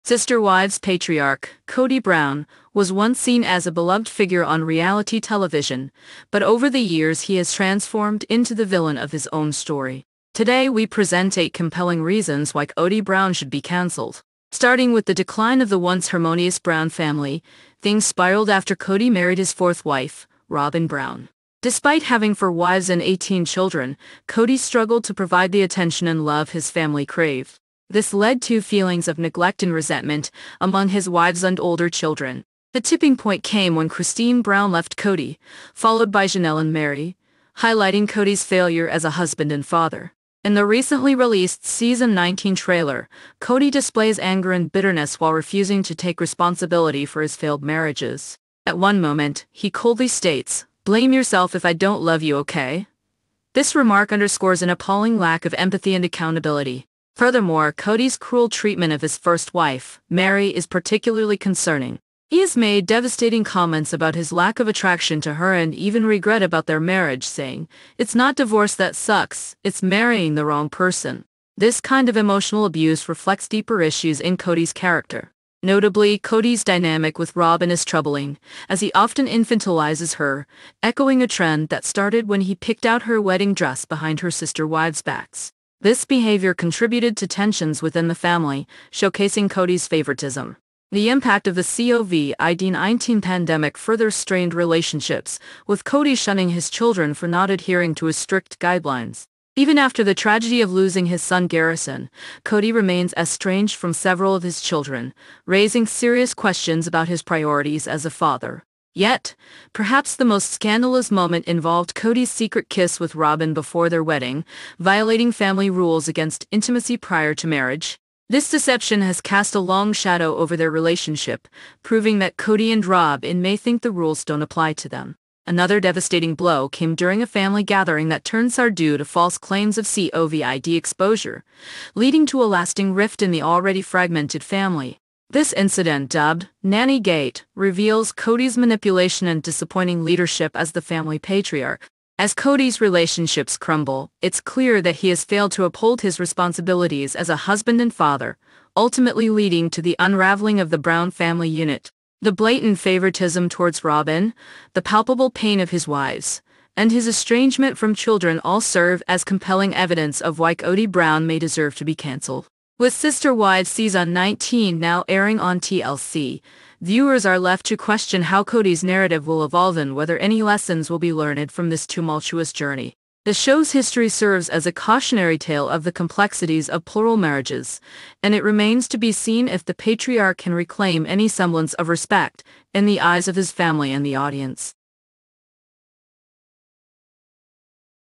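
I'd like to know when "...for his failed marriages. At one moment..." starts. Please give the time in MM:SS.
00:47.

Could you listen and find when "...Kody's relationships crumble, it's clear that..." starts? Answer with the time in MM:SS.
02:22.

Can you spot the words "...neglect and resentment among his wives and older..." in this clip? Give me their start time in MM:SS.
00:29.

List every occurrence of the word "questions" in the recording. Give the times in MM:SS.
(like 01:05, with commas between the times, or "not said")
01:46, 02:47.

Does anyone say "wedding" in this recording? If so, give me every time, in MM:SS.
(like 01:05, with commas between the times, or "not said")
01:23, 01:54.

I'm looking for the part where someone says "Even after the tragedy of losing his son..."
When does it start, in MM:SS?
01:39.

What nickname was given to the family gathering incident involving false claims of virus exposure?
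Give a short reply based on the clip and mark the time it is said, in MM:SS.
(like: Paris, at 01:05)
Nanny Gate, at 02:16.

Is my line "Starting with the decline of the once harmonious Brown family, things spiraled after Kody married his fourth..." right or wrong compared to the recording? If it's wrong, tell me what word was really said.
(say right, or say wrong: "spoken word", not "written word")
right.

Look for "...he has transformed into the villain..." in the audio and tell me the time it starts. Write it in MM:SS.
00:07.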